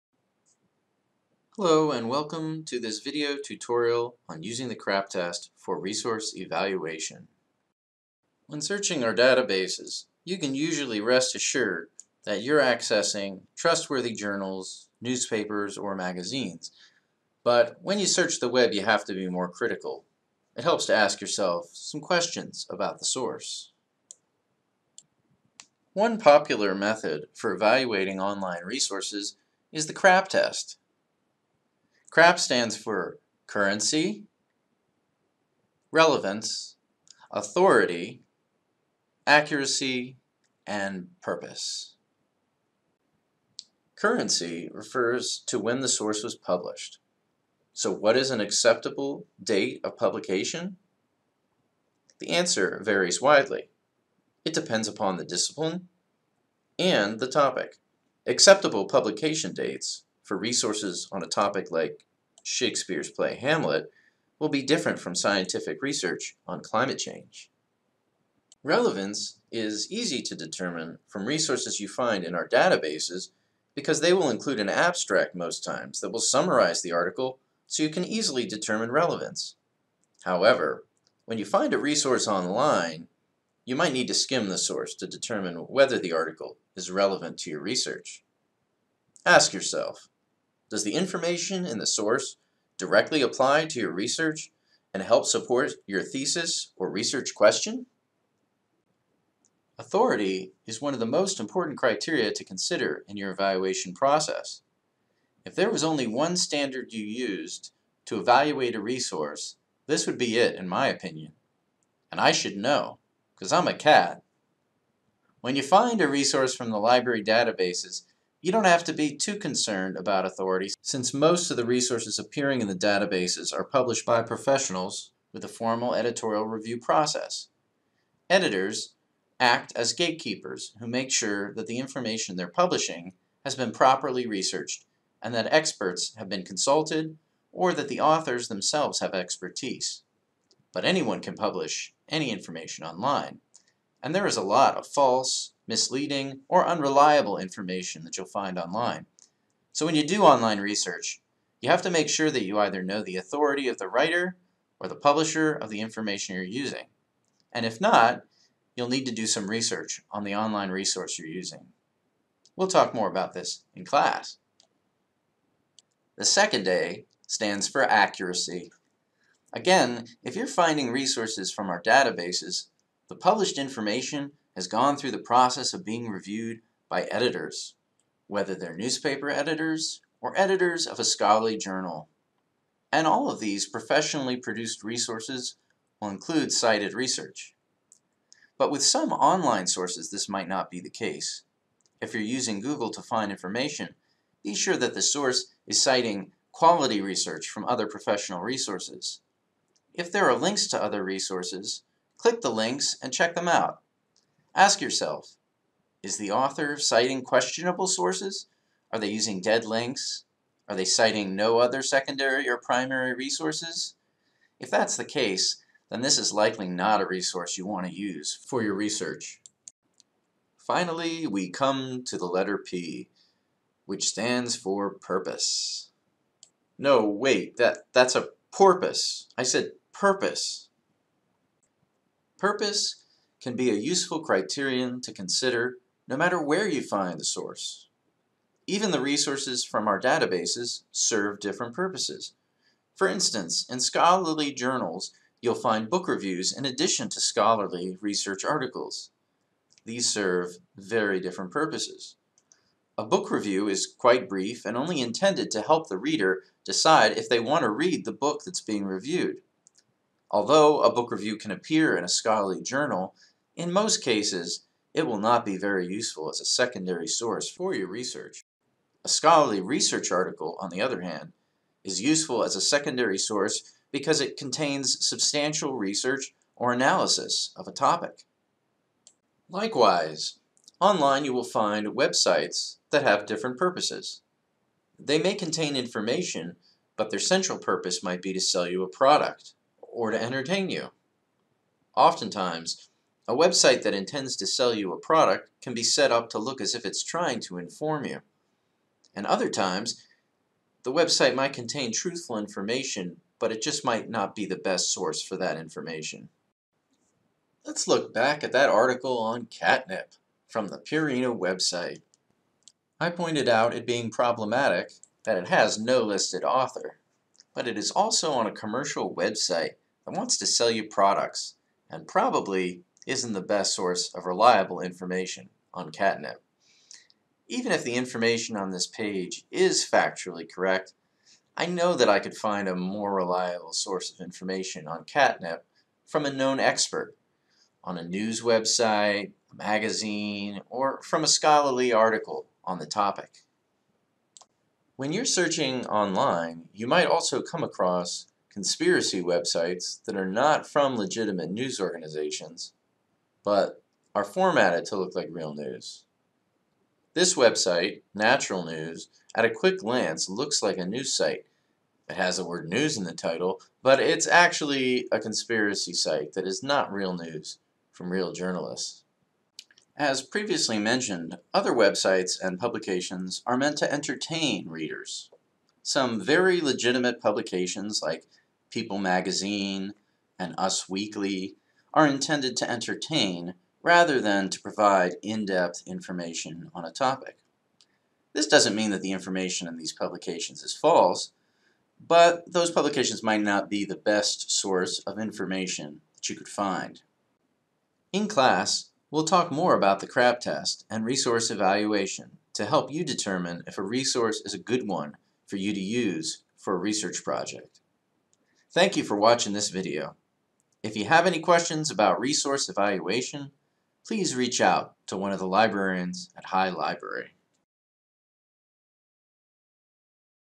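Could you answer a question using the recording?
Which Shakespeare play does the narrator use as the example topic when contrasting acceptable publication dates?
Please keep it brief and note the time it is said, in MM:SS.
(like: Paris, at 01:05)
Hamlet, at 01:03.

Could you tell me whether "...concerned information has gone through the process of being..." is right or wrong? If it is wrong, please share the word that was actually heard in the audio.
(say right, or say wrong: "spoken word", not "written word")
wrong: "published", not "concerned".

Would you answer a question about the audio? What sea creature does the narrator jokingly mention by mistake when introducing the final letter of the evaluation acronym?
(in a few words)
Porpoise.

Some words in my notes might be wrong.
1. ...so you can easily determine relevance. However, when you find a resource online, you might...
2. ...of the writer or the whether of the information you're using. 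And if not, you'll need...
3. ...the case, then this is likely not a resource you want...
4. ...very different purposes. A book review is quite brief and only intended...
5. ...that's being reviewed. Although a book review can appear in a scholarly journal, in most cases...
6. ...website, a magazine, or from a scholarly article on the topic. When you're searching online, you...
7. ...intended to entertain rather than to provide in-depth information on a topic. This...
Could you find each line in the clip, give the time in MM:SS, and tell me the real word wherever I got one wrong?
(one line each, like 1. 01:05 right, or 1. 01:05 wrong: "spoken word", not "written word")
1. 01:17 right
2. 02:33 wrong: "publisher", not "whether"
3. 03:34 right
4. 04:10 right
5. 04:18 right
6. 05:38 right
7. 06:22 right.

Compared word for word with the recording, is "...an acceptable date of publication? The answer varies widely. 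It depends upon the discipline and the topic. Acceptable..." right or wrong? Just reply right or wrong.
right.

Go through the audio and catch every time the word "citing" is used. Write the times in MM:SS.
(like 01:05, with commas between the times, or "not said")
03:15, 03:26, 03:30.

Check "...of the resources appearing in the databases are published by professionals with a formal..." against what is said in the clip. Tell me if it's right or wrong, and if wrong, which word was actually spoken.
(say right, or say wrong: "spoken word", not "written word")
right.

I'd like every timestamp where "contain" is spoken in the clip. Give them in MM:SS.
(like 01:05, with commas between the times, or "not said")
04:34, 04:45, 05:01.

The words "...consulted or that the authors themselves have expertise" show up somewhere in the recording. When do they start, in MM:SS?
02:16.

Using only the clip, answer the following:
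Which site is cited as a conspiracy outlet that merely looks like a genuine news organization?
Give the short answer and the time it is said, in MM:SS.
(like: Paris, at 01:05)
Natural News, at 05:58.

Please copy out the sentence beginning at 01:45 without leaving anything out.
If there was only one standard you used to evaluate a resource, this would be it in my opinion.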